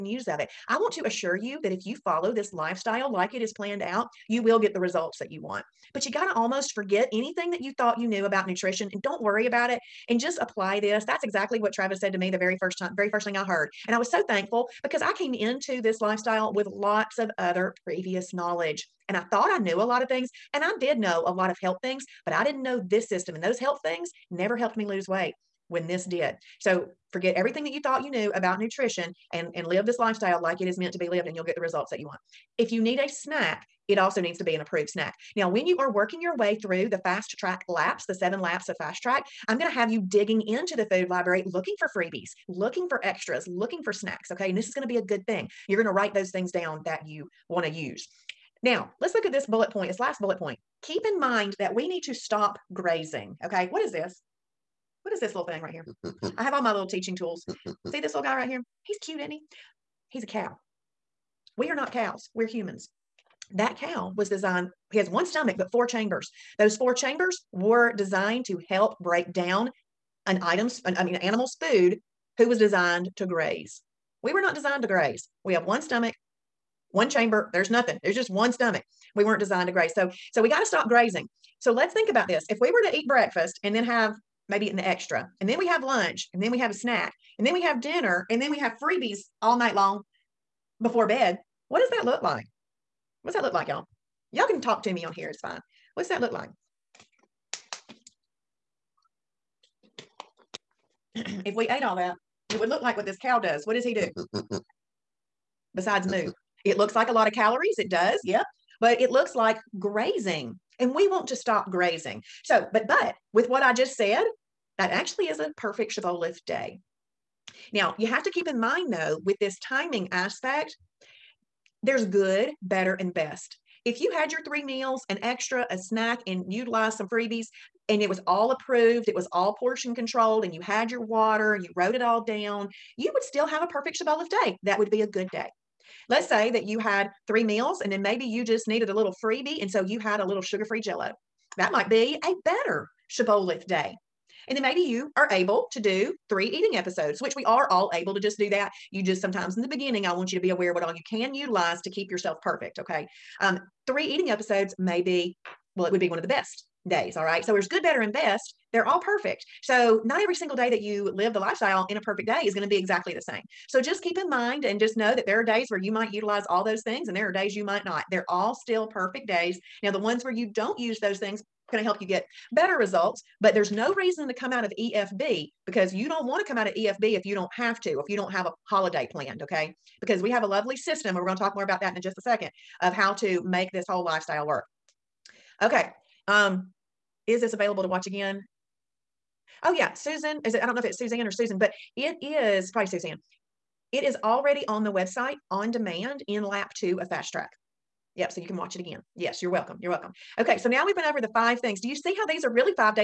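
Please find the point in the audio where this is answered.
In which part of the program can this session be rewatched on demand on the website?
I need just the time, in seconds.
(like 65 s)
196 s.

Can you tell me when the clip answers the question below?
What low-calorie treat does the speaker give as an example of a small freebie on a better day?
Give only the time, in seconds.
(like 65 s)
140 s.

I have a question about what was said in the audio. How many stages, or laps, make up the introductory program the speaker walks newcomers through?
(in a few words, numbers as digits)
7.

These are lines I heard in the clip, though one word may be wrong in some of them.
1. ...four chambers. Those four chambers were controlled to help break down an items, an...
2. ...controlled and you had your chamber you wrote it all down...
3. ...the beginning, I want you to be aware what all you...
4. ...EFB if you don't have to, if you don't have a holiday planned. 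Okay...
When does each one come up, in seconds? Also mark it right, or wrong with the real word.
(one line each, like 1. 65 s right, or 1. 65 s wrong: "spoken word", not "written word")
1. 65 s wrong: "designed", not "controlled"
2. 129 s wrong: "water", not "chamber"
3. 149 s right
4. 176 s right.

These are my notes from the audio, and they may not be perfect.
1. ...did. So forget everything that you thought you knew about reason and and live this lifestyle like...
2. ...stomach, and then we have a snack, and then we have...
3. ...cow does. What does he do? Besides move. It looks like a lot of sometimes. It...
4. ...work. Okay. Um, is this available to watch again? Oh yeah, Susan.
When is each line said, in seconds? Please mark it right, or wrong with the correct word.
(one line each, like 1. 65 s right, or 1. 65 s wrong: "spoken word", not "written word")
1. 26 s wrong: "nutrition", not "reason"
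2. 85 s wrong: "lunch", not "stomach"
3. 103 s wrong: "calories", not "sometimes"
4. 184 s right.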